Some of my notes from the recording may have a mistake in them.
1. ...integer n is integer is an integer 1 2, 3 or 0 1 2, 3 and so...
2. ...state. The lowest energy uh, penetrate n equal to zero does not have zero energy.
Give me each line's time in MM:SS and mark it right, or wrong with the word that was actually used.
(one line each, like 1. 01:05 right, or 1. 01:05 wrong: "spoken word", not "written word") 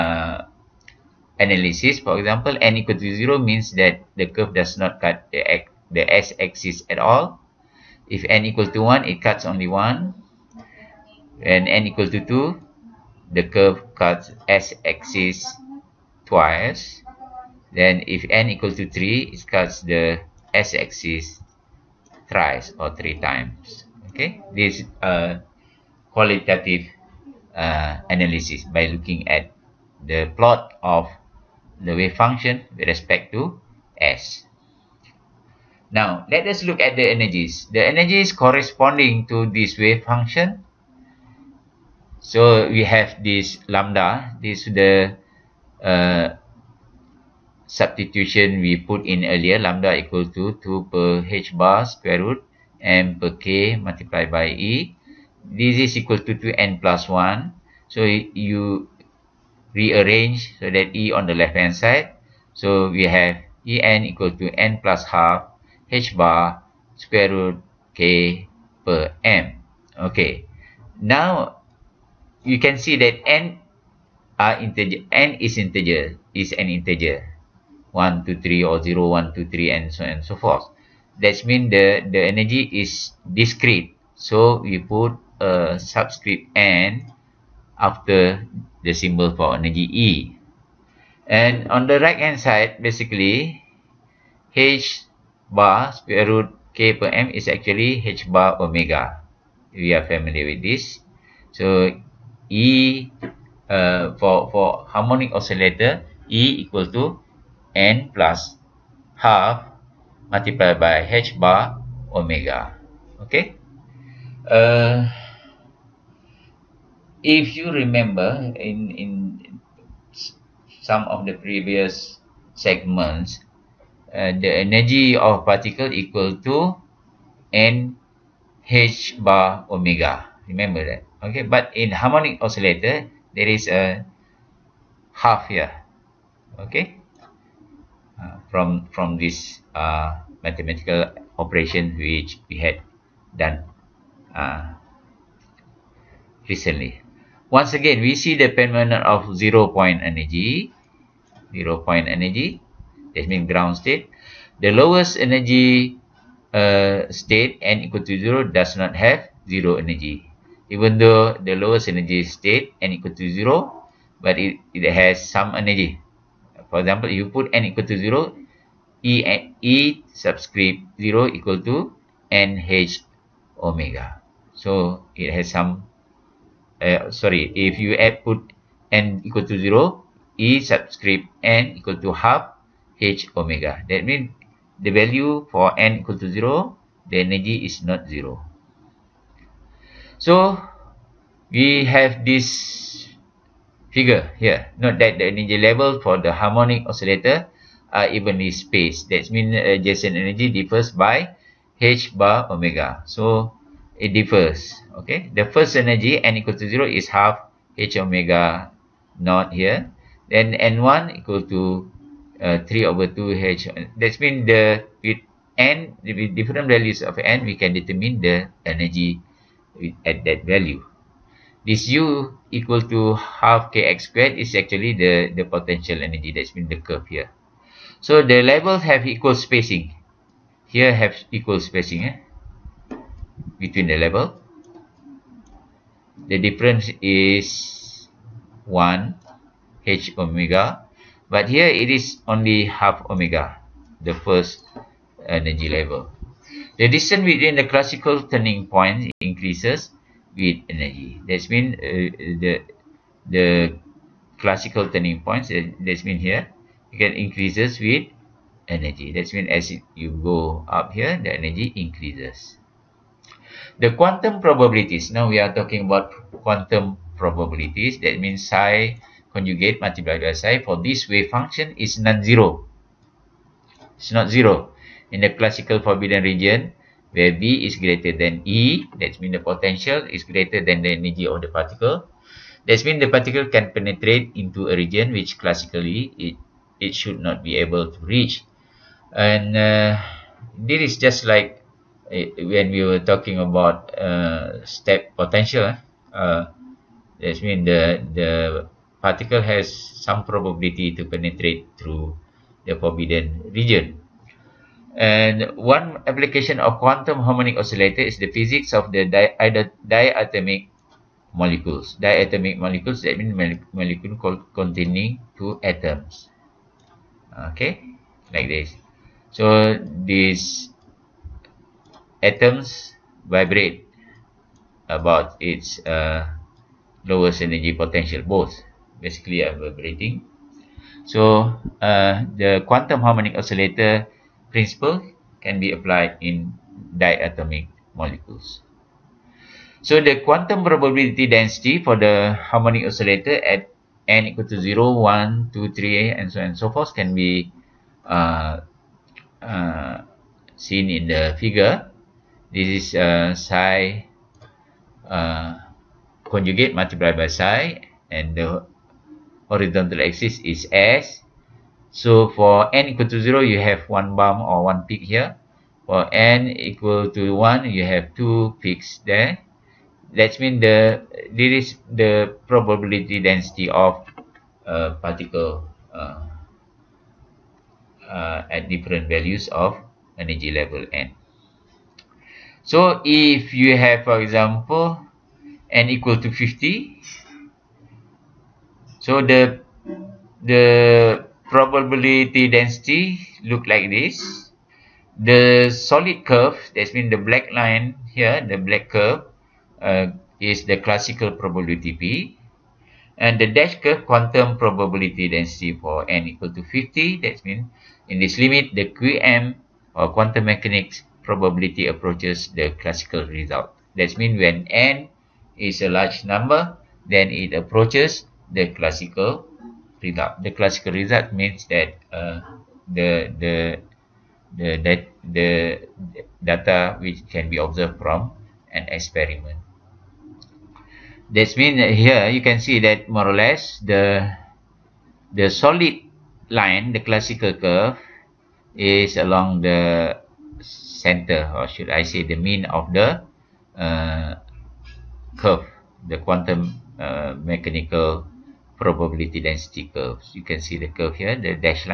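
1. 01:14 right
2. 02:33 wrong: "state", not "penetrate".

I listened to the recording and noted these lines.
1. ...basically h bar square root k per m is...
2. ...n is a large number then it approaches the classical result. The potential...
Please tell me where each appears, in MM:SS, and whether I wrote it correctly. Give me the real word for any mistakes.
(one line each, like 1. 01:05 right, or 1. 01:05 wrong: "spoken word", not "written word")
1. 01:32 right
2. 06:54 wrong: "classical", not "potential".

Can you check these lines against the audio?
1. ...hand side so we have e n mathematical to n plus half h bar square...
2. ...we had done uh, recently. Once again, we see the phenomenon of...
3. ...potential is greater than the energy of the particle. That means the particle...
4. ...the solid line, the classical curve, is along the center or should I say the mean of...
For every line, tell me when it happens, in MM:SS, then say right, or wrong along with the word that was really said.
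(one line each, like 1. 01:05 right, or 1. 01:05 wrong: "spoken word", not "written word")
1. 01:01 wrong: "equal", not "mathematical"
2. 02:22 right
3. 04:39 right
4. 07:15 right.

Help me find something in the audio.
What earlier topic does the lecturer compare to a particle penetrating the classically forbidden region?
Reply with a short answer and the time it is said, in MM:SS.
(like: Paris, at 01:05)
step potential, at 04:54.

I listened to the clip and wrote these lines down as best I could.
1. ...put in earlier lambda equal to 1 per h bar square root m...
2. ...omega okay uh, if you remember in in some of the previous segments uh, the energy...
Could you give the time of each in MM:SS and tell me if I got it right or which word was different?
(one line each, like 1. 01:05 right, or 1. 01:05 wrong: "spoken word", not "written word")
1. 00:48 wrong: "2", not "1"
2. 01:52 right.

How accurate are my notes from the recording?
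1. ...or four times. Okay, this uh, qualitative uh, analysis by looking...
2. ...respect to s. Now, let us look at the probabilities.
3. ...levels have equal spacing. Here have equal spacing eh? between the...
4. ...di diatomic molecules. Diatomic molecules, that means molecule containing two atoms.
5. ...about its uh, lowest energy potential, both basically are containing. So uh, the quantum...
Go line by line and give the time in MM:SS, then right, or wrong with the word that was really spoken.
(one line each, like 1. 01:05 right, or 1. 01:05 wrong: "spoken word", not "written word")
1. 00:22 wrong: "three", not "four"
2. 00:32 wrong: "energies", not "probabilities"
3. 03:48 right
4. 05:09 right
5. 05:24 wrong: "vibrating", not "containing".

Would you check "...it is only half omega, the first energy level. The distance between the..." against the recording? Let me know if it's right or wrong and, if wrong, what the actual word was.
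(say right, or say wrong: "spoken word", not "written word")
right.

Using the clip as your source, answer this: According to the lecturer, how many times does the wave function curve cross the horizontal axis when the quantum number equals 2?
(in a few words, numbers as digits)
twice.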